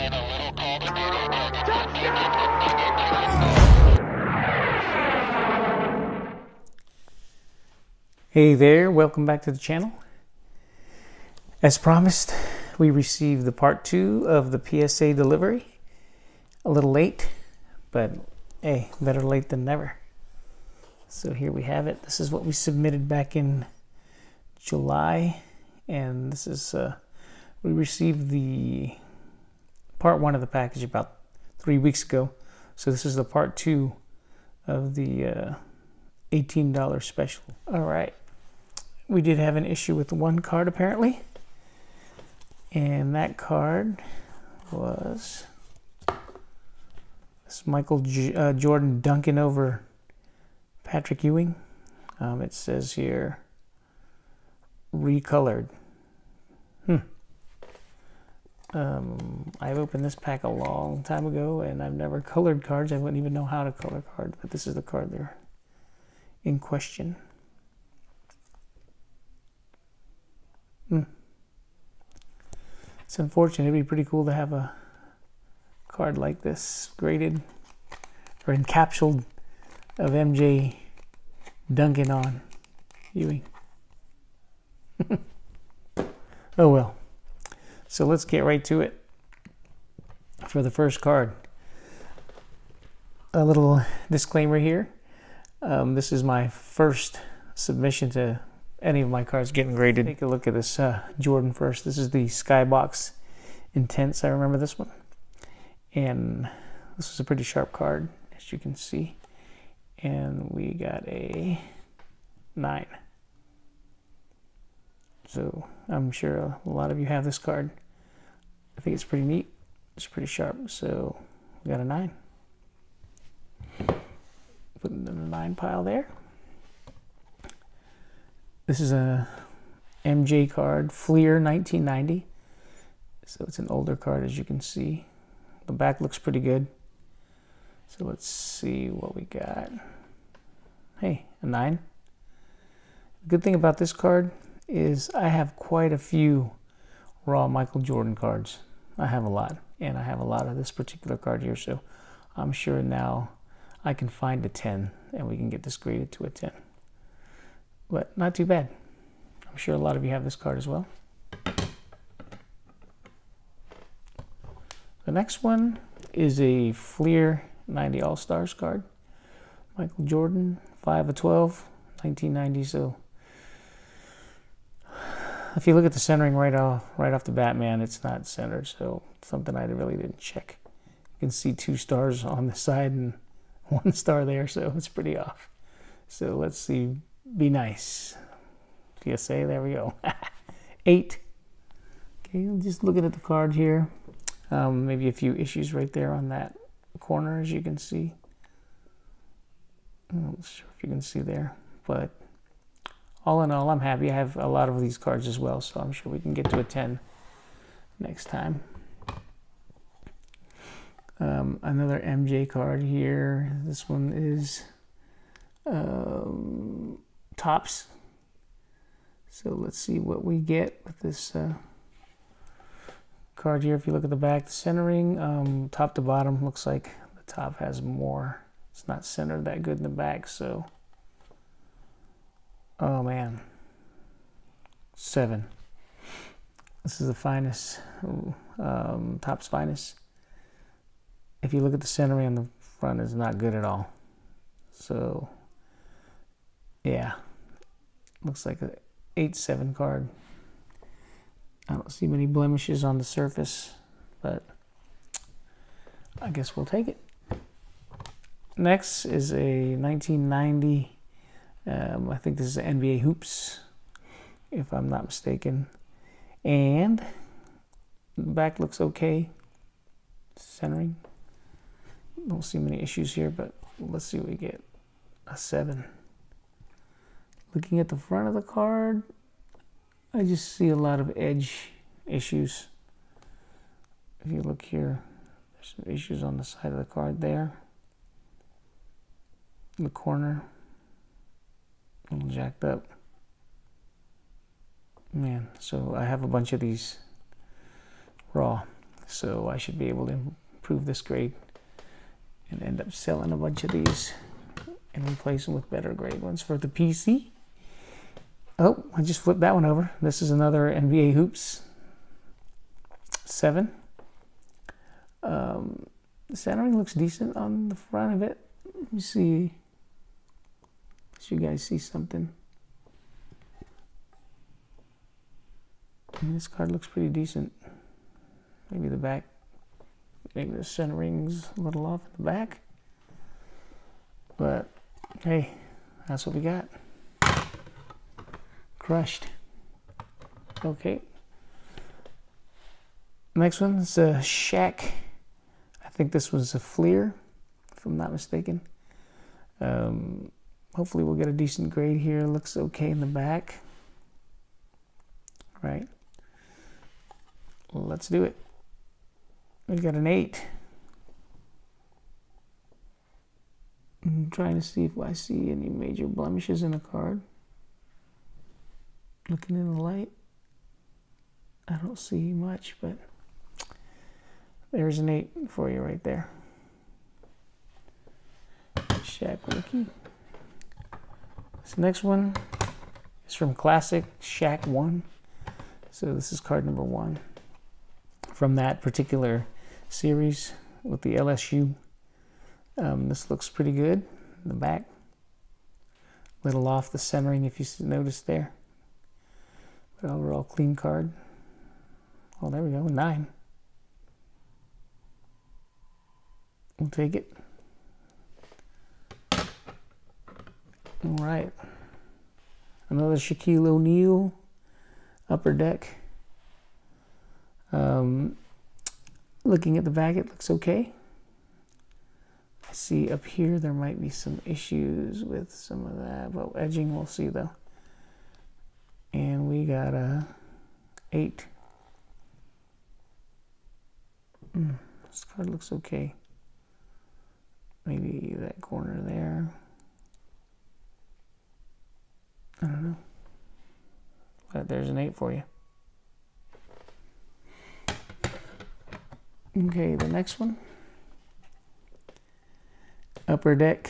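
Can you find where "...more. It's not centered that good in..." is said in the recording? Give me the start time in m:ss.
3:47.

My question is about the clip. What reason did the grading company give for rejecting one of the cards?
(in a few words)
Recolored.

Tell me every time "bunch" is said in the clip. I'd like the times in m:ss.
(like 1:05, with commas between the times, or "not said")
4:56, 5:03.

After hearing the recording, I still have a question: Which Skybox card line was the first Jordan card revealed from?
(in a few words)
Intense.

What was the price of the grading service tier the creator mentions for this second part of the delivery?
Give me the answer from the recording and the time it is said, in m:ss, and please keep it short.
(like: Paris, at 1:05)
$18, at 0:36.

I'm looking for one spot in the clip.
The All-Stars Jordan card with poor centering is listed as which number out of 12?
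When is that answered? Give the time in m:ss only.
2:50.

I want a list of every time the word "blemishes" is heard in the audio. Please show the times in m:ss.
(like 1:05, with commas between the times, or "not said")
4:12, 6:06.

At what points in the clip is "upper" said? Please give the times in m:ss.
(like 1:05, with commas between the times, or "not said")
6:55, 7:33.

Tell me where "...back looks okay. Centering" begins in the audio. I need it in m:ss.
4:28.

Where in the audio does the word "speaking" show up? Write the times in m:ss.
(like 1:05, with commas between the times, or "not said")
not said.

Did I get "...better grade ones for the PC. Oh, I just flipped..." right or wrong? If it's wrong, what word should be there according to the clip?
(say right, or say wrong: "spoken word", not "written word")
right.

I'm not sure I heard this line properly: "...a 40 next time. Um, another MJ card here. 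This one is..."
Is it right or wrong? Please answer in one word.
wrong.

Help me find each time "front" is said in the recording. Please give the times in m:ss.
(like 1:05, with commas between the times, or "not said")
4:02, 4:37, 5:17.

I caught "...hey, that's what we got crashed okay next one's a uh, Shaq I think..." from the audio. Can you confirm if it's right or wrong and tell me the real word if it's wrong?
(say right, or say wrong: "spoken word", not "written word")
right.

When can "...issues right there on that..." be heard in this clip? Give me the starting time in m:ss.
3:15.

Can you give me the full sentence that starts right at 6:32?
Um, this looks pretty good in the back.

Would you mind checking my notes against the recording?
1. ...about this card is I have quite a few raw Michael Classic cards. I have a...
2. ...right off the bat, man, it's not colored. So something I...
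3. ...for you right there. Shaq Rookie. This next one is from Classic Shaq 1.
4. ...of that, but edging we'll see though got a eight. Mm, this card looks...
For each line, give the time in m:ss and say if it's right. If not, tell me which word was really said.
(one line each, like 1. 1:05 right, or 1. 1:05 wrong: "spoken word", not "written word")
1. 2:23 wrong: "Jordan", not "Classic"
2. 2:56 wrong: "centered", not "colored"
3. 6:15 right
4. 7:05 right.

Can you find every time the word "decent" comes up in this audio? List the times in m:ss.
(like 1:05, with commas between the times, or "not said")
5:16, 5:27, 5:51.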